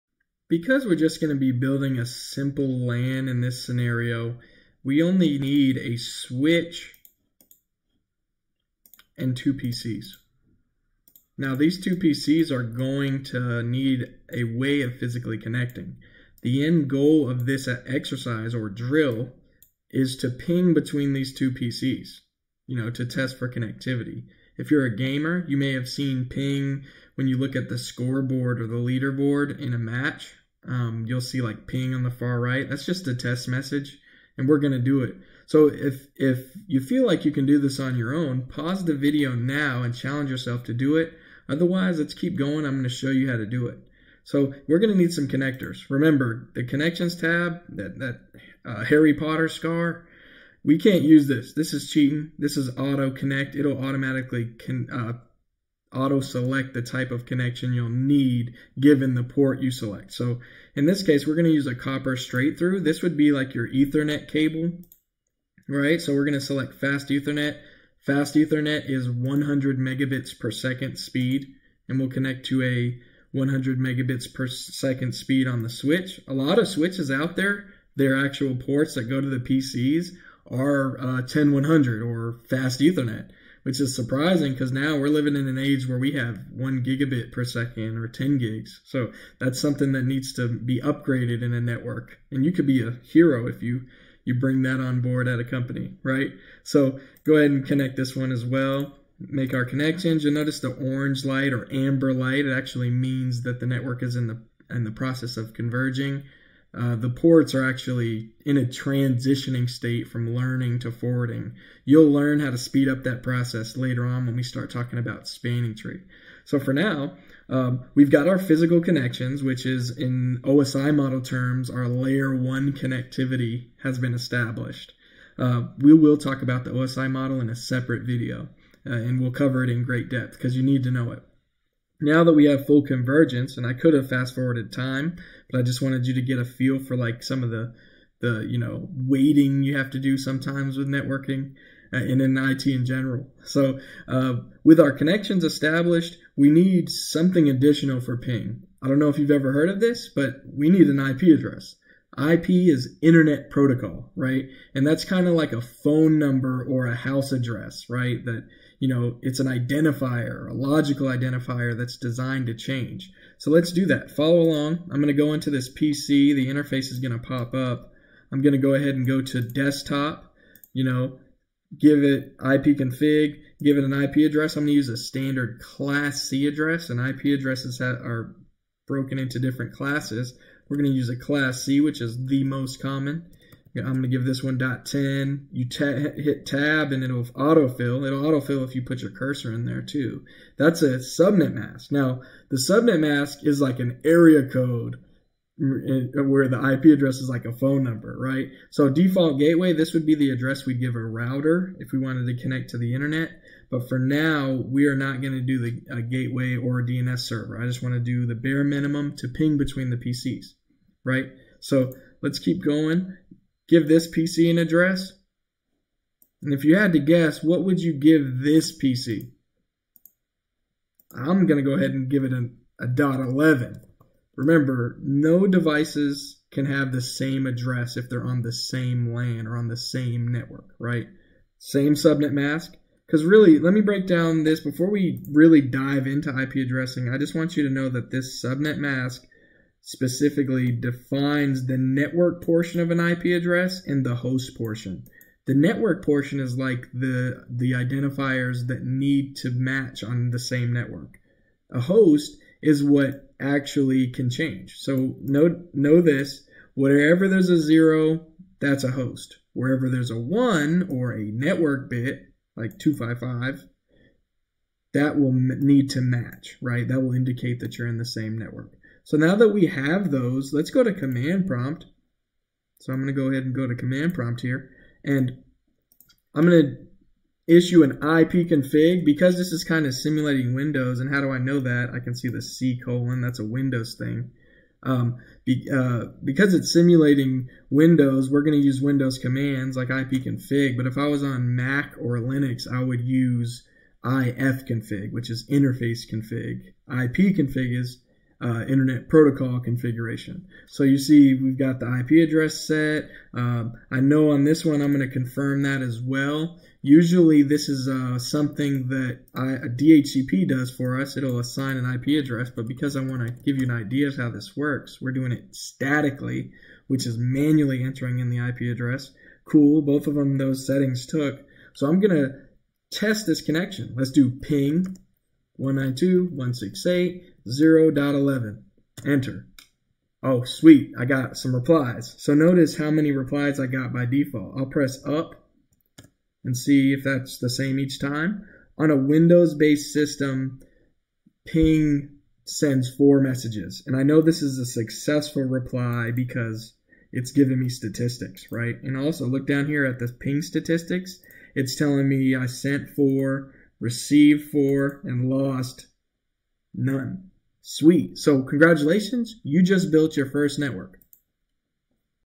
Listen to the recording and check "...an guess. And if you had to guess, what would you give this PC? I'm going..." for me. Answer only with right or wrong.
wrong.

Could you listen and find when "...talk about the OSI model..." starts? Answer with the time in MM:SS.
02:06.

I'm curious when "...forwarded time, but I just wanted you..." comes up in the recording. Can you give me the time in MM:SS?
02:14.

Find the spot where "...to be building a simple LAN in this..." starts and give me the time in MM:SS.
00:01.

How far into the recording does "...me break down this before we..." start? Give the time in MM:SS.
03:53.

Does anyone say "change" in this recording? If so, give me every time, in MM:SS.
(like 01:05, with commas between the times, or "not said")
02:42, 04:14.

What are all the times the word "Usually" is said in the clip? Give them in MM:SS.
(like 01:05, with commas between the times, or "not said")
05:06.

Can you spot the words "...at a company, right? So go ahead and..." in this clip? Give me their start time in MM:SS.
01:35.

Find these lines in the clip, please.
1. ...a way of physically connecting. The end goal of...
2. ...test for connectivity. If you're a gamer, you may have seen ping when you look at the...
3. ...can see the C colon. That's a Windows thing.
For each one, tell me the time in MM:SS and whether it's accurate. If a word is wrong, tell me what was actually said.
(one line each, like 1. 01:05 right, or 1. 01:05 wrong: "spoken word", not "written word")
1. 00:14 right
2. 00:23 right
3. 04:41 right.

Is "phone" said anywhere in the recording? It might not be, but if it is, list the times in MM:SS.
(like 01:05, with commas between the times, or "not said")
02:35, 03:17.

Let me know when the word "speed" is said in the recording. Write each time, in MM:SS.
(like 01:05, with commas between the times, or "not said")
01:10, 01:15, 01:52.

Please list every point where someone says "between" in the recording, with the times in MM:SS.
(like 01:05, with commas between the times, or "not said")
00:20, 03:29.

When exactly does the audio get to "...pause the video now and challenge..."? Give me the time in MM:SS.
00:38.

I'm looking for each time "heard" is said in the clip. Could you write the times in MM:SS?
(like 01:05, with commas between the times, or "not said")
02:29.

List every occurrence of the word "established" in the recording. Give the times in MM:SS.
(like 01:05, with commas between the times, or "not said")
02:04, 02:25.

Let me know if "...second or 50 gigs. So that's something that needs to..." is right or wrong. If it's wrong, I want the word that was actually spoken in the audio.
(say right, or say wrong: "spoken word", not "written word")
wrong: "10", not "50".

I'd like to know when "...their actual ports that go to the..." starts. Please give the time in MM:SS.
01:17.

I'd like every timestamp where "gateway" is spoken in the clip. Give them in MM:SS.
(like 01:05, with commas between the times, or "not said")
03:19, 03:25.